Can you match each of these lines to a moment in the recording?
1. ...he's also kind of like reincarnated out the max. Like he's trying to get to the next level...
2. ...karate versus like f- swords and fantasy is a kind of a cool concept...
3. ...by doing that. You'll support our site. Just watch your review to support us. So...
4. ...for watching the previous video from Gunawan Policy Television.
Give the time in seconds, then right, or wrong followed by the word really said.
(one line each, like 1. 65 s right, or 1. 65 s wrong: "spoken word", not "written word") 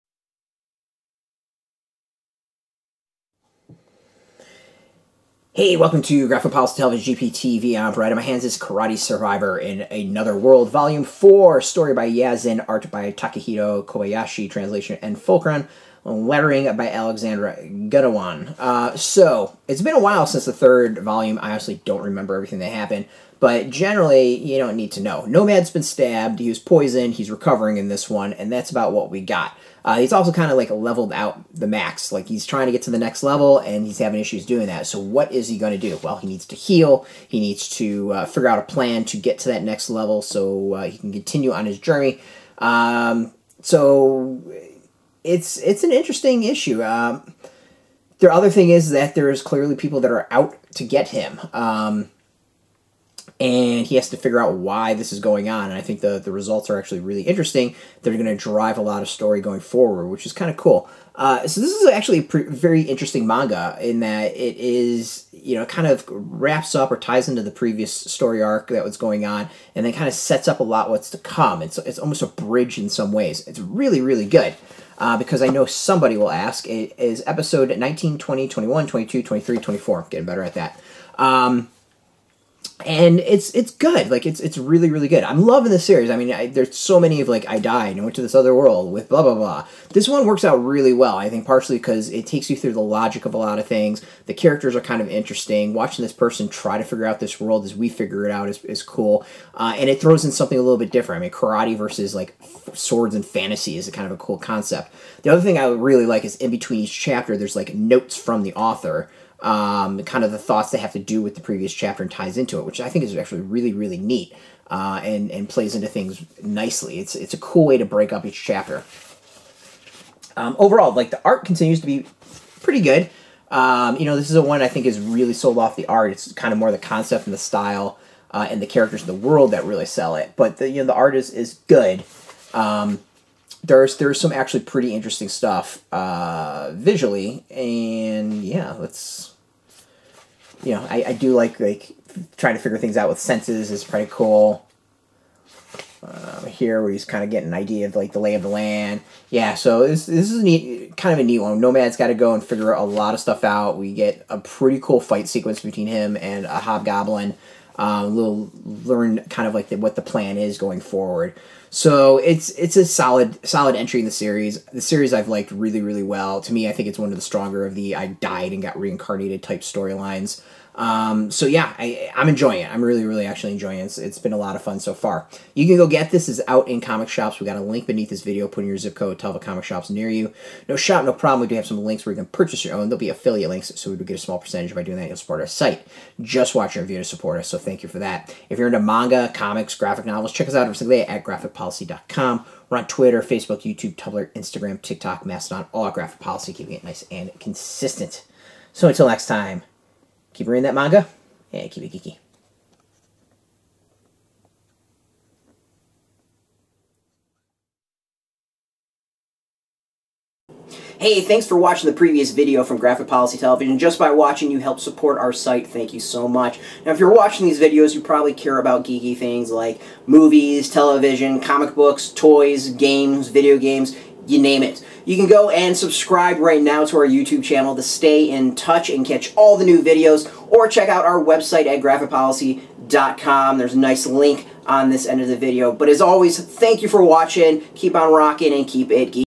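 1. 29 s wrong: "leveled", not "reincarnated"
2. 101 s right
3. 184 s right
4. 211 s wrong: "Graphic", not "Gunawan".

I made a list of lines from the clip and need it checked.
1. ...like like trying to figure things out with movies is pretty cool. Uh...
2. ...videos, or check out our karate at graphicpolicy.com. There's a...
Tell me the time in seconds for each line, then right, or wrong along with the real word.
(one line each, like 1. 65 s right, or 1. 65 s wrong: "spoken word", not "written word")
1. 141 s wrong: "senses", not "movies"
2. 229 s wrong: "website", not "karate".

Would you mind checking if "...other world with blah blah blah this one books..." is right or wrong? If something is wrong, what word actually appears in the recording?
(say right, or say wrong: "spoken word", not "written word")
wrong: "works", not "books".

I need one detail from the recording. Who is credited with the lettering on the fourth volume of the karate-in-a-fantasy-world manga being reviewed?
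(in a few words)
Alexandra Gunawan.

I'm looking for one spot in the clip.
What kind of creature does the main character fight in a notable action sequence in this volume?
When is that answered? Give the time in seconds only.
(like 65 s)
156 s.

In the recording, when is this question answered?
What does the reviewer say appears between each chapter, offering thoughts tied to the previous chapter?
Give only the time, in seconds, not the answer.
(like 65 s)
107 s.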